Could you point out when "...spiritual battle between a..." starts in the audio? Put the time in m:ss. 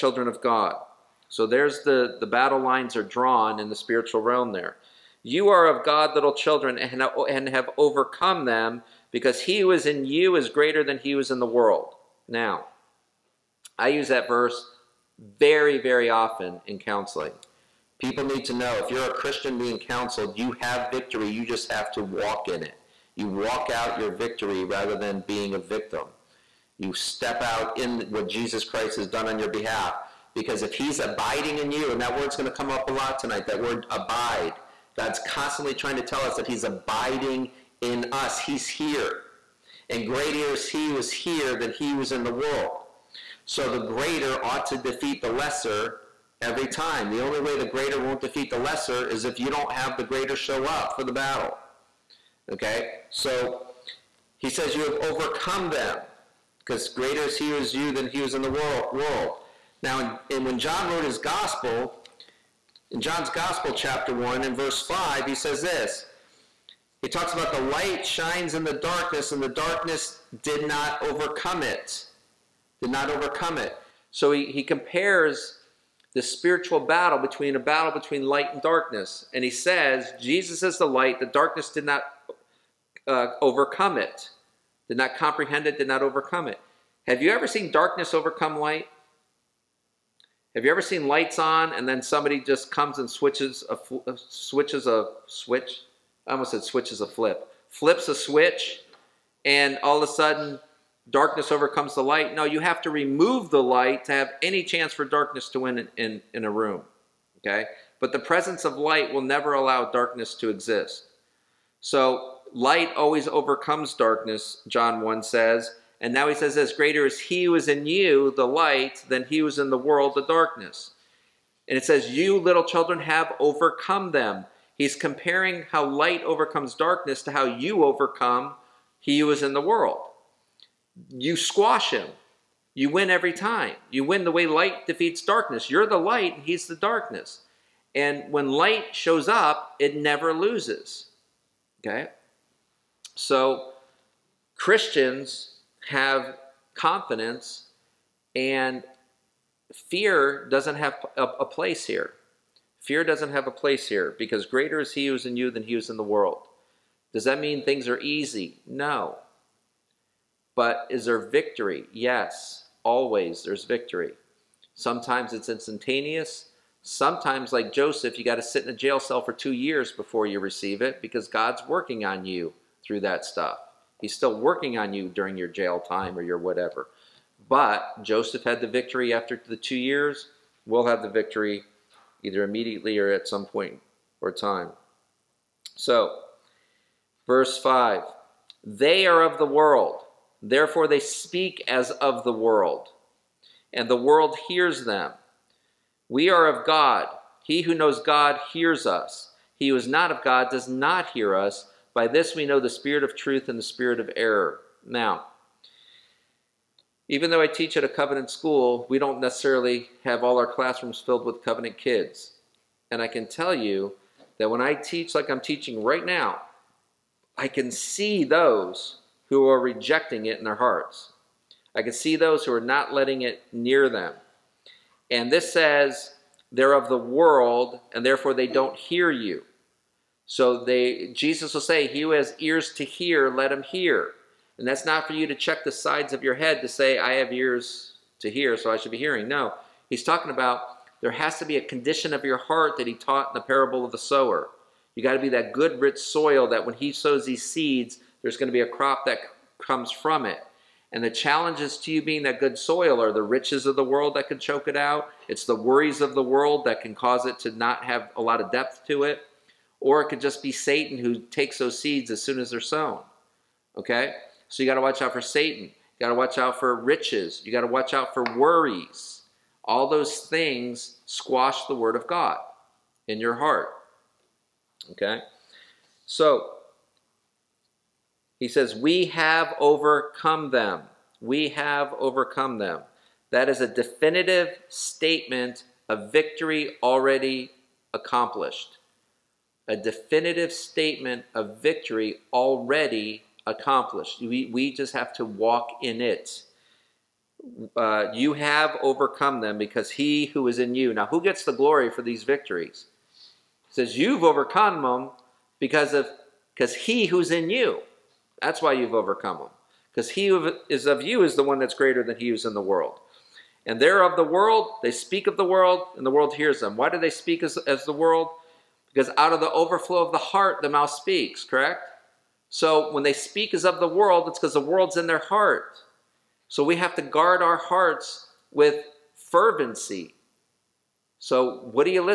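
1:16.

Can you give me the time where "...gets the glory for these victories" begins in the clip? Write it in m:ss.
5:01.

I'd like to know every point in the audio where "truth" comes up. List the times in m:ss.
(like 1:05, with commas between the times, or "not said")
3:23.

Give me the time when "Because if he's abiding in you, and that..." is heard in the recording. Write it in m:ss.
0:30.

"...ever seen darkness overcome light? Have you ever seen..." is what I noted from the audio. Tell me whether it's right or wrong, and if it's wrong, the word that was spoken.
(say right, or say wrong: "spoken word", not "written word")
right.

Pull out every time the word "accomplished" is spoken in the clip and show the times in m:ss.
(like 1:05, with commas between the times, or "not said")
4:47, 4:53.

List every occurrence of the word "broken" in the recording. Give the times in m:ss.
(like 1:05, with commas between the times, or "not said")
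not said.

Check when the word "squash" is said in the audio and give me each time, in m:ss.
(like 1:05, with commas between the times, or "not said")
2:11, 4:31.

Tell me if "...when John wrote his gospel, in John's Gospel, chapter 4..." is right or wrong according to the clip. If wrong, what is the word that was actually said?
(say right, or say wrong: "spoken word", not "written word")
wrong: "1", not "4".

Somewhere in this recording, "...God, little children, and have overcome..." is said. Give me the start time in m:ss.
0:05.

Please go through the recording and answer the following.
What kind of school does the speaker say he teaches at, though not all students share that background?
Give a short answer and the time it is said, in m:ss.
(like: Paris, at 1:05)
A covenant school, at 3:27.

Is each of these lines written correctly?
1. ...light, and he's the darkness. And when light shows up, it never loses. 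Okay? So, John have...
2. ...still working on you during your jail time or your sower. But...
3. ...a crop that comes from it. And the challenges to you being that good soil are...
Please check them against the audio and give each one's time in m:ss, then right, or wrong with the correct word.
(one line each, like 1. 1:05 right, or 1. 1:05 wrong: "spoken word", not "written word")
1. 2:15 wrong: "Christians", not "John"
2. 2:54 wrong: "whatever", not "sower"
3. 4:08 right.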